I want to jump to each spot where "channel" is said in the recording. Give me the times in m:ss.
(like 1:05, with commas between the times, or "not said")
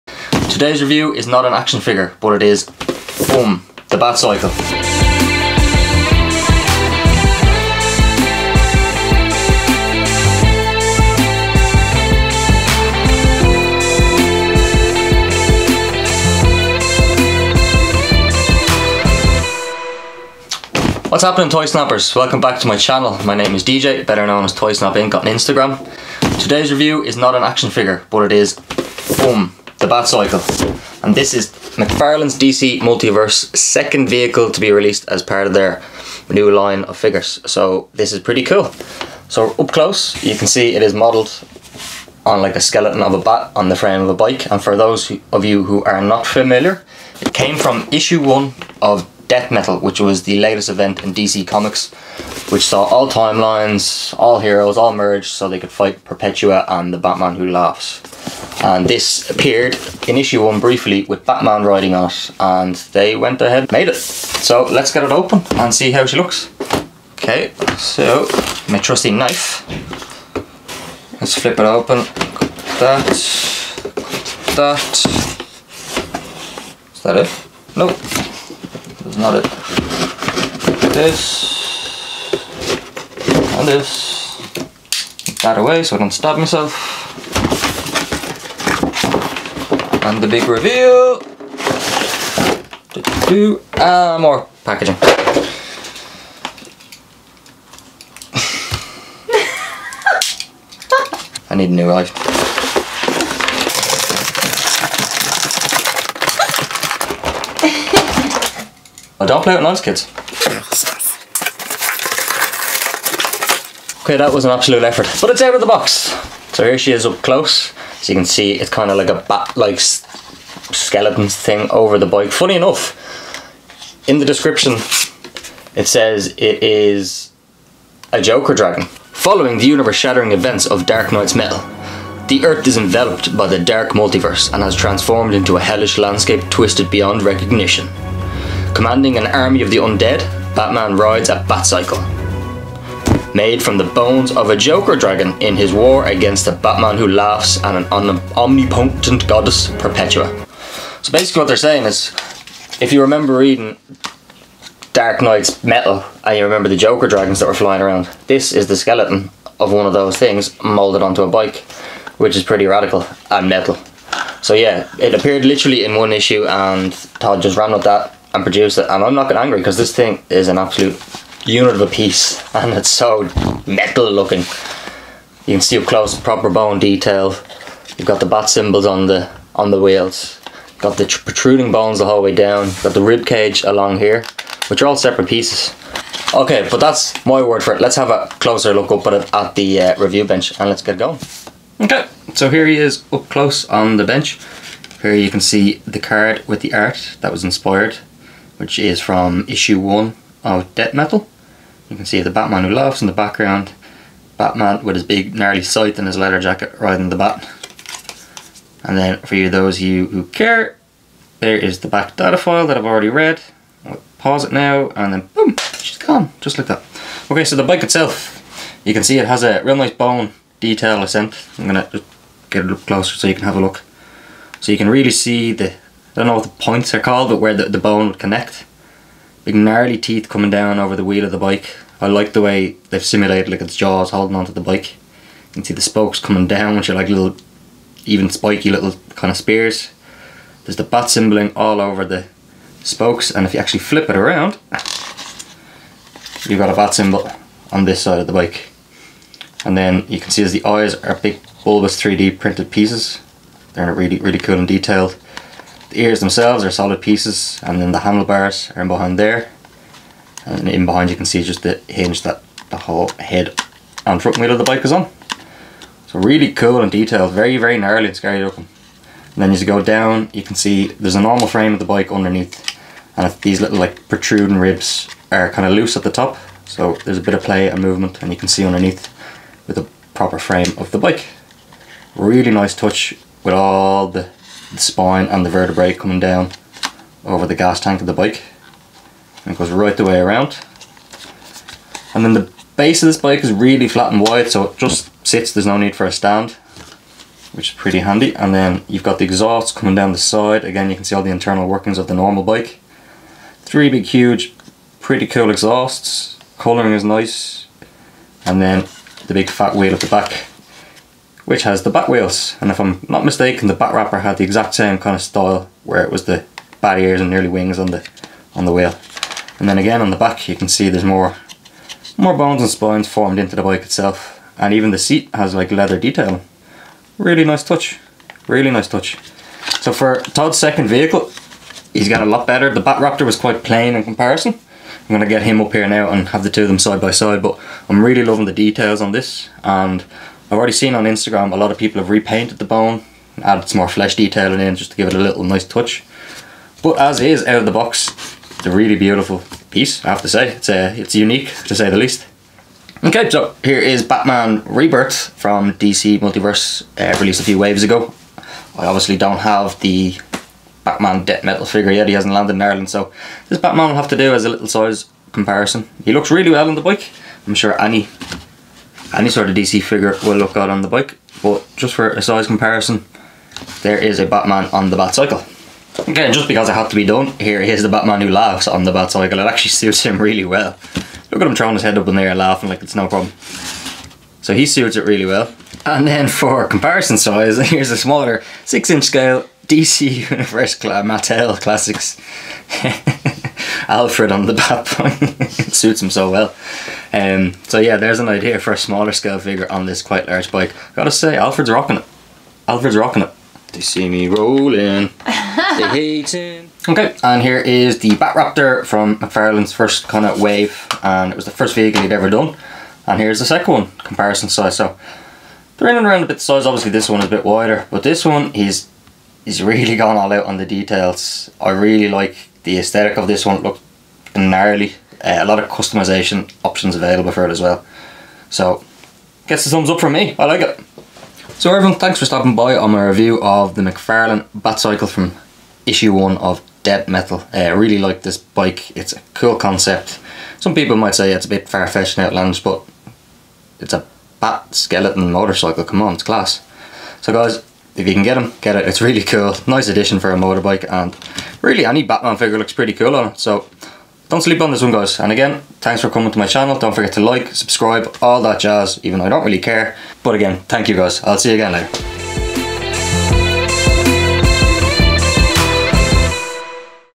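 0:22, 7:36.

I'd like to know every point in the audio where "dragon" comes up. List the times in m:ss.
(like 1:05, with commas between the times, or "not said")
2:08, 2:24, 2:37.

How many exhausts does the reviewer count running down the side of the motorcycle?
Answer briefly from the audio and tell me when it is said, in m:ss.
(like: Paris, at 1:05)
3, at 5:03.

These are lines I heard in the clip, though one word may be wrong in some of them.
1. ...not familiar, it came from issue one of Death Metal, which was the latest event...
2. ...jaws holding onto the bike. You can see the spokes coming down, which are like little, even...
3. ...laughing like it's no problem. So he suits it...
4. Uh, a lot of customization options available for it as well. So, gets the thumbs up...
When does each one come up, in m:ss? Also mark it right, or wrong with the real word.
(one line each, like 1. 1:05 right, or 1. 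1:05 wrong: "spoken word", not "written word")
1. 0:46 right
2. 3:53 right
3. 6:22 right
4. 7:05 right.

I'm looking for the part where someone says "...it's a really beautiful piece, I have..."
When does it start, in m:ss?
5:48.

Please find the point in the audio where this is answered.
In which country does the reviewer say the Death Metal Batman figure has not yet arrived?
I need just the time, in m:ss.
6:02.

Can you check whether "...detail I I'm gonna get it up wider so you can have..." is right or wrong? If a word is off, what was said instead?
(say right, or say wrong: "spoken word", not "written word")
wrong: "closer", not "wider".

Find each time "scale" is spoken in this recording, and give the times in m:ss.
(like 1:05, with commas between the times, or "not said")
6:29, 6:39.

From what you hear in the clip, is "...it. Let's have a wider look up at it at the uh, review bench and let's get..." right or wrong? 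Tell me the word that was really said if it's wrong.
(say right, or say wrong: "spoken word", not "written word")
wrong: "closer", not "wider".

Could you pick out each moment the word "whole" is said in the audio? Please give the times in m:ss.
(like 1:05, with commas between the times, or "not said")
3:02, 4:22.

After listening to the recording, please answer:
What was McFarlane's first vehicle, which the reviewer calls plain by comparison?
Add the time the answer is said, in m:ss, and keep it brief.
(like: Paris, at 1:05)
Batraptor, at 5:32.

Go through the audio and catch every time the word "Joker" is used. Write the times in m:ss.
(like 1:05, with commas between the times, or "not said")
2:08, 2:24, 2:36.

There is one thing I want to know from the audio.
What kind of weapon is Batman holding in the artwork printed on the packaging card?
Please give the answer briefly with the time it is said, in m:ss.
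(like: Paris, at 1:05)
scythe, at 3:25.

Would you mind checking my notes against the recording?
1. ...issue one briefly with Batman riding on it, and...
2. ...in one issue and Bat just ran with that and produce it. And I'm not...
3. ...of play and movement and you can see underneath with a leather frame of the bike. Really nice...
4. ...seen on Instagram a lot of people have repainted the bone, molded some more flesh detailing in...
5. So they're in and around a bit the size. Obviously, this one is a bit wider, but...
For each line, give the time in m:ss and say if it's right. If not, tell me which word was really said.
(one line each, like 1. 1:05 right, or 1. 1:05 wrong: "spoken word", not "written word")
1. 1:00 right
2. 2:45 wrong: "Todd", not "Bat"
3. 4:37 wrong: "proper", not "leather"
4. 5:40 wrong: "added", not "molded"
5. 6:54 right.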